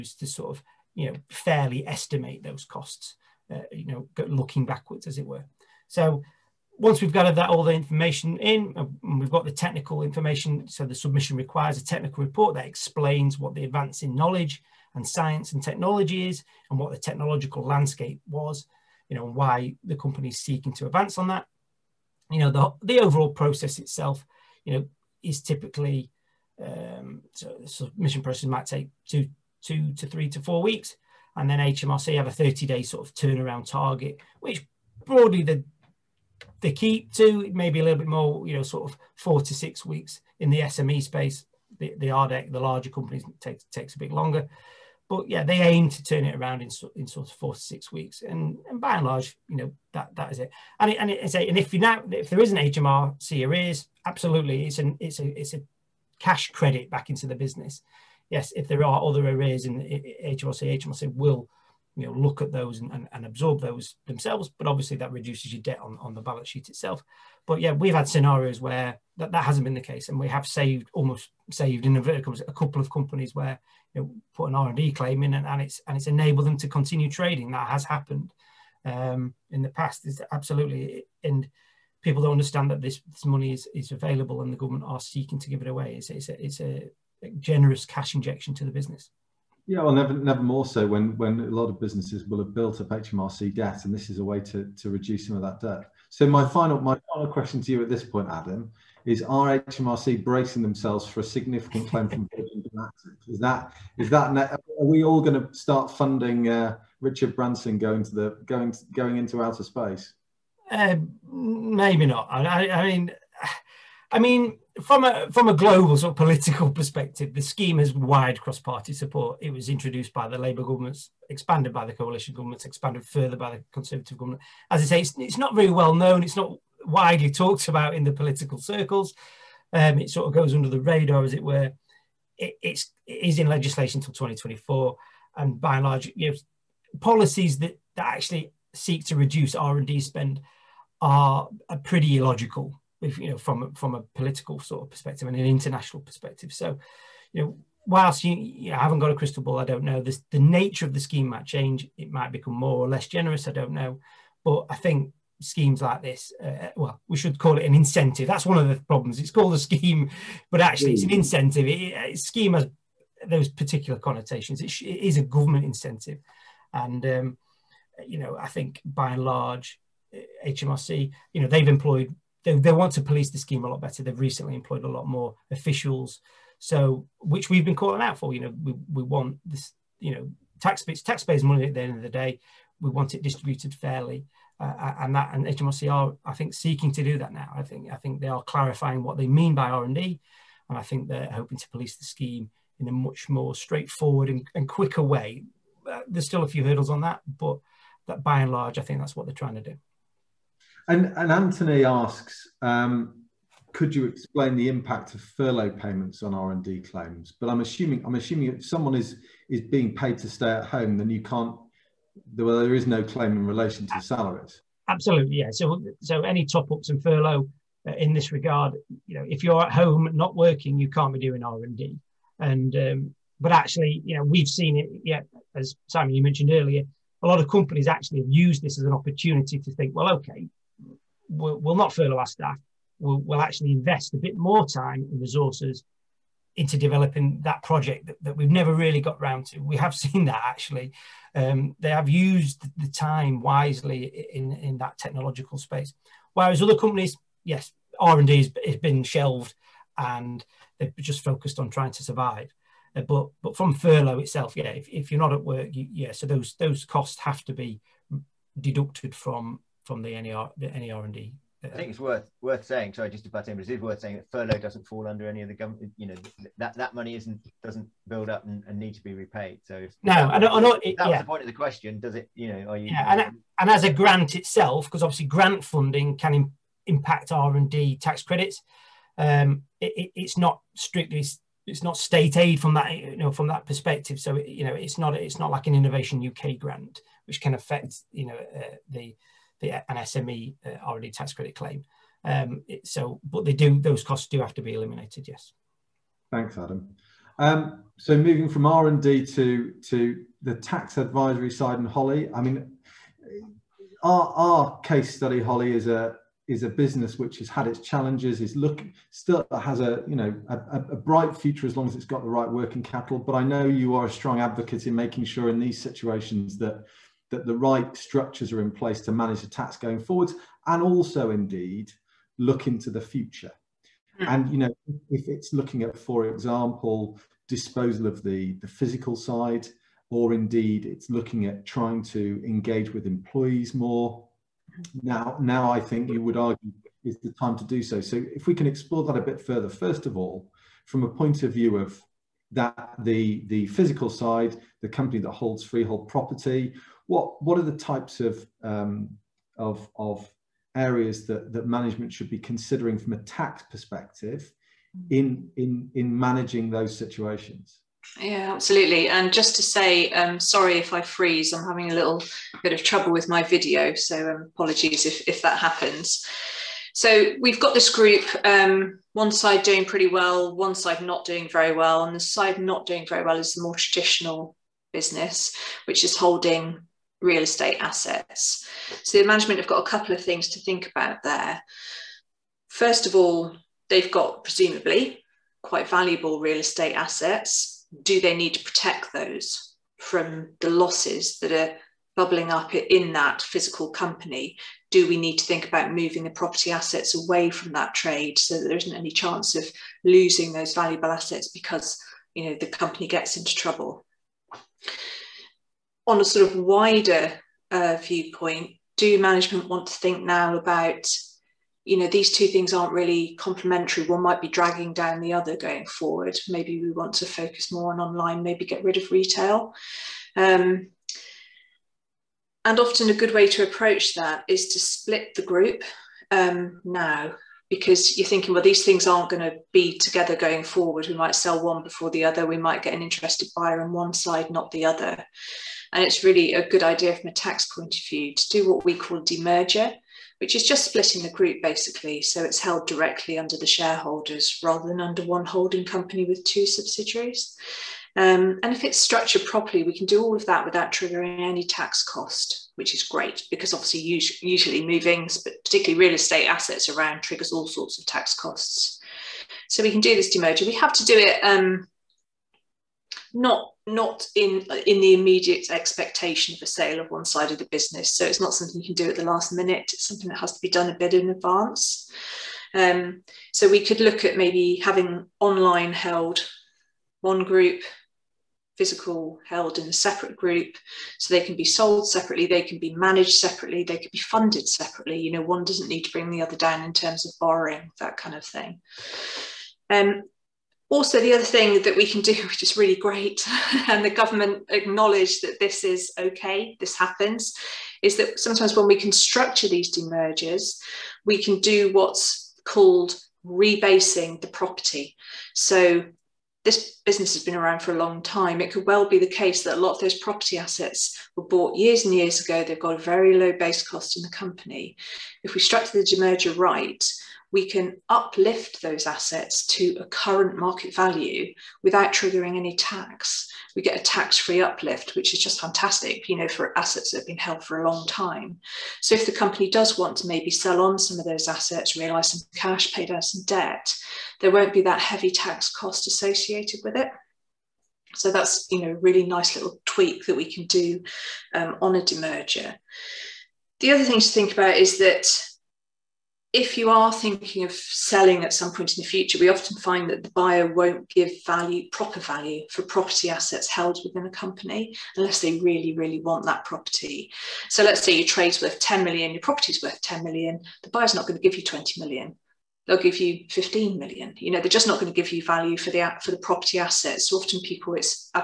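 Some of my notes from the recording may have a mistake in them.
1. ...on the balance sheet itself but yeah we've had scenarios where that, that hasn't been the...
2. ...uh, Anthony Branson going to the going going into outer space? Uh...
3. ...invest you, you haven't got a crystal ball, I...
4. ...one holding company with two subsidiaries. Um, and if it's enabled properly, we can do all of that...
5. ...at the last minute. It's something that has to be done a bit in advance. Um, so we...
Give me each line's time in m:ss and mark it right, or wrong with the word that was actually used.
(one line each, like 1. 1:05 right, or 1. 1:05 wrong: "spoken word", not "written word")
1. 1:05 right
2. 1:46 wrong: "Richard", not "Anthony"
3. 2:27 wrong: "whilst", not "invest"
4. 7:25 wrong: "structured", not "enabled"
5. 7:49 right.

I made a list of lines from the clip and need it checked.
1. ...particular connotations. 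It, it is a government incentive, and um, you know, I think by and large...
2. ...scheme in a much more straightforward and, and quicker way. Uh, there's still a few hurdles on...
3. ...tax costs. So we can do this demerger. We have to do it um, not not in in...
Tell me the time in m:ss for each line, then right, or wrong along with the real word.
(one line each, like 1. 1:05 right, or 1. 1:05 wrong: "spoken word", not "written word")
1. 2:43 right
2. 3:12 right
3. 7:38 right.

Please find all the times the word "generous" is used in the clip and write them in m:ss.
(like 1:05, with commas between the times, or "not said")
1:27, 2:33.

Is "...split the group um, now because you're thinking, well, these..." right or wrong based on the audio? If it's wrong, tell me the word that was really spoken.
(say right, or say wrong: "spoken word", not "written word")
right.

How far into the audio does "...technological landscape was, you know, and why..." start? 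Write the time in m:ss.
0:16.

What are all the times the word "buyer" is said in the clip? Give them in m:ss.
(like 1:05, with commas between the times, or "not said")
7:13, 9:10, 9:20.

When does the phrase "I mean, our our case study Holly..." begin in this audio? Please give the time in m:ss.
5:02.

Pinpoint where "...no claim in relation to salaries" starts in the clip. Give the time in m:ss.
3:32.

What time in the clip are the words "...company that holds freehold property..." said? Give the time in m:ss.
5:44.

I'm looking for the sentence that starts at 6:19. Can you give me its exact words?
So the management have got a couple of things to think about there.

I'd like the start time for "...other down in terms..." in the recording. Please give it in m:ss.
8:06.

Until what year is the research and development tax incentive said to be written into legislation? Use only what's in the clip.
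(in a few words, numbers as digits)
2024.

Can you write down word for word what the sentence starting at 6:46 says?
on a sort of wider uh, viewpoint, do management want to think now about, you know, these two things aren't really complementary.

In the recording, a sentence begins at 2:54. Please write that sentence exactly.
They've recently employed a lot more officials, so which we've been calling out for.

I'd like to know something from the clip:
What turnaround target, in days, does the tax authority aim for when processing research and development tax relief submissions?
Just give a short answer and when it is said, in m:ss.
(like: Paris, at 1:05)
30 days, at 0:32.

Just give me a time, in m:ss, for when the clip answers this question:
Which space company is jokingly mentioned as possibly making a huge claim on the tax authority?
1:42.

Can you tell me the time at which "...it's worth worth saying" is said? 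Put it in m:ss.
4:21.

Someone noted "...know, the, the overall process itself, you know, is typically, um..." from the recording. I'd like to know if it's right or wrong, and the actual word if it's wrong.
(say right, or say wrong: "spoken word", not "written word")
right.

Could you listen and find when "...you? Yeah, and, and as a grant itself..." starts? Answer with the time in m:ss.
4:32.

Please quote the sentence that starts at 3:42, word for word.
And um, but actually, you know, we've seen it.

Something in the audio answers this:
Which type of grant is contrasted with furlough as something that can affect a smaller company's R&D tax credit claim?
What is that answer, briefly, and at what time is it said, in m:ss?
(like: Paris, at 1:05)
Innovation UK grant, at 4:45.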